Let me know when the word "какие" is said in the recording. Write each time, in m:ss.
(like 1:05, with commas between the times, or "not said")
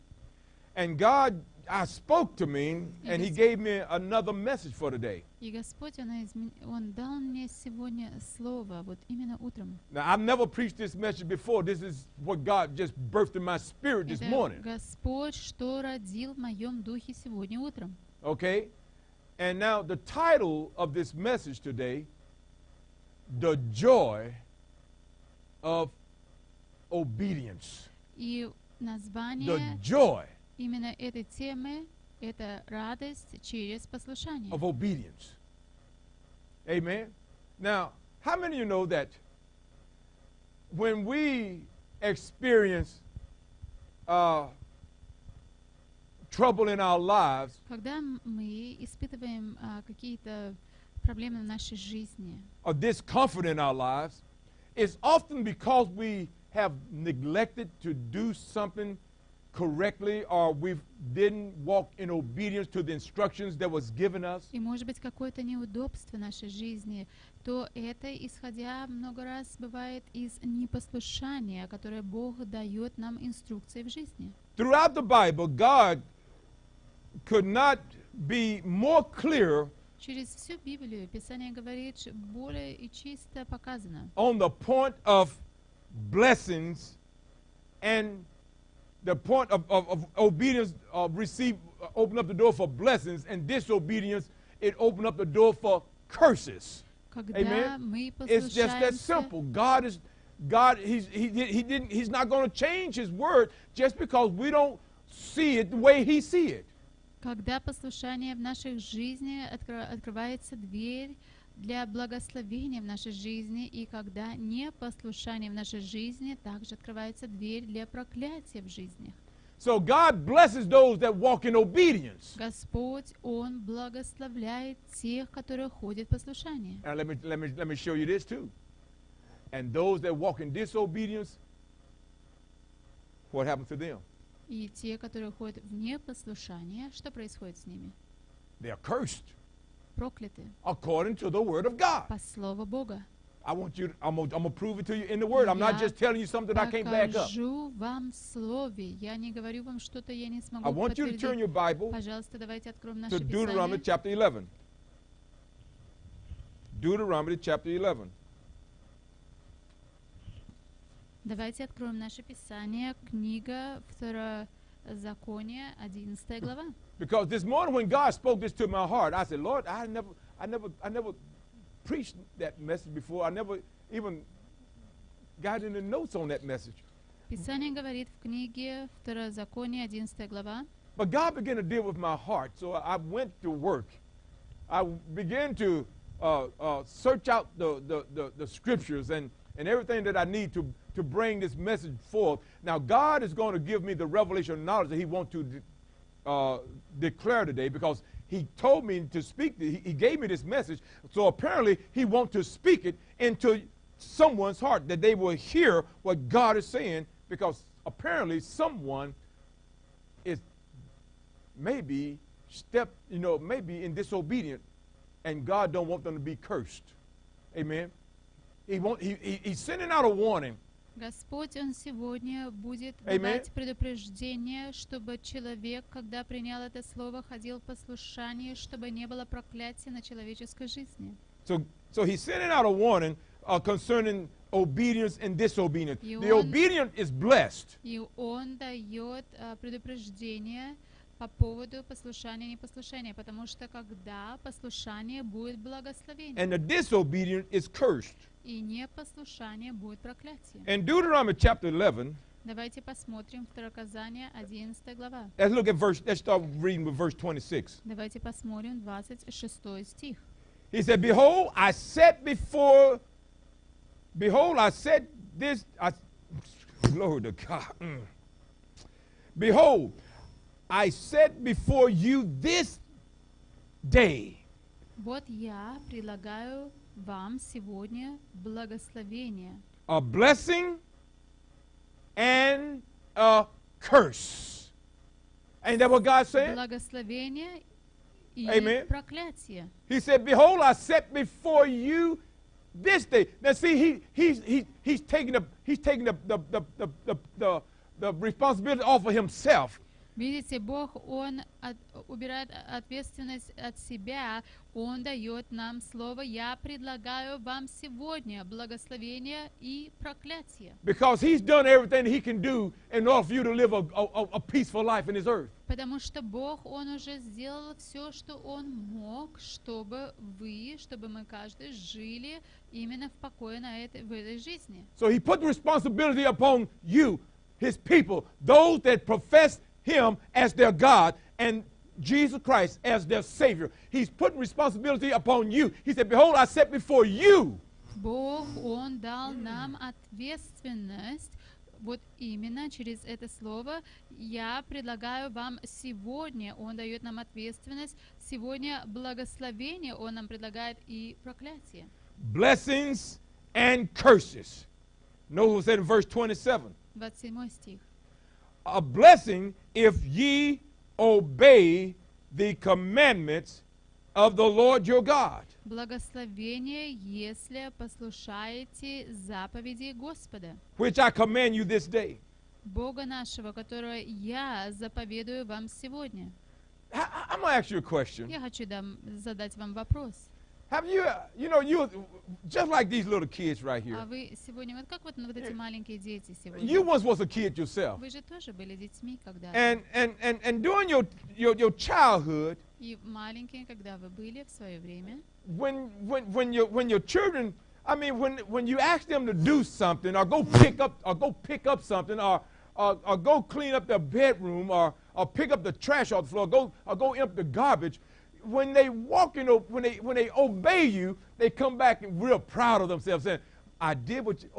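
0:49.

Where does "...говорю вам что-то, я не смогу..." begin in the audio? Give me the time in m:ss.
2:29.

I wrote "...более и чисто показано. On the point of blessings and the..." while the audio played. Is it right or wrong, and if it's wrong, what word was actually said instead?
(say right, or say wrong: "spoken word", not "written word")
right.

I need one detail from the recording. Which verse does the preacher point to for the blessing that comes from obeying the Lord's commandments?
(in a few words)
27.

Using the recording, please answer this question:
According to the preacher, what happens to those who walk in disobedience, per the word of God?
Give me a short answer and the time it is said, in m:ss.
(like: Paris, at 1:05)
They are cursed, at 2:18.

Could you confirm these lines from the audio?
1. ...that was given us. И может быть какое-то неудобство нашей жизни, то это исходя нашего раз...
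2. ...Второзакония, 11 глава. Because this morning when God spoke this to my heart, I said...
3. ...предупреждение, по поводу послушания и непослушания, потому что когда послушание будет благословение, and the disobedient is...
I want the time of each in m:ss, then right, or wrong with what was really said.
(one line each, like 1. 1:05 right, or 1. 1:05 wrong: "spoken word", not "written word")
1. 1:03 wrong: "много", not "нашего"
2. 2:43 right
3. 3:59 right.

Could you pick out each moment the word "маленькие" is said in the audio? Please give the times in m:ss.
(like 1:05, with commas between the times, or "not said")
6:25, 6:33.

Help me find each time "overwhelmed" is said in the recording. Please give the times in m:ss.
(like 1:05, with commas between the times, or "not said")
not said.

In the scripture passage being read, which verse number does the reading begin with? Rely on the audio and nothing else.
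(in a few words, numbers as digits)
26.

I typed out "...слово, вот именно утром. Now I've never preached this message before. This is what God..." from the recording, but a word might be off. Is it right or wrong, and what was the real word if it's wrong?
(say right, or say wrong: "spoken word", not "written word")
right.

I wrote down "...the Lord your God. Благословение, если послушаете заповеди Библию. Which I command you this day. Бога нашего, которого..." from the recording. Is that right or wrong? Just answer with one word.
wrong.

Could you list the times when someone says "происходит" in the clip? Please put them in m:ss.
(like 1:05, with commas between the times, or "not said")
2:17.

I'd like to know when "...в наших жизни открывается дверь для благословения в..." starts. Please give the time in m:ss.
1:48.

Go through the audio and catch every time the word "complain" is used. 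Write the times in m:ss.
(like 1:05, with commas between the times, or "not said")
not said.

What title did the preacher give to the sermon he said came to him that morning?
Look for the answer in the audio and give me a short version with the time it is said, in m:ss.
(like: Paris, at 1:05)
The joy of obedience, at 0:23.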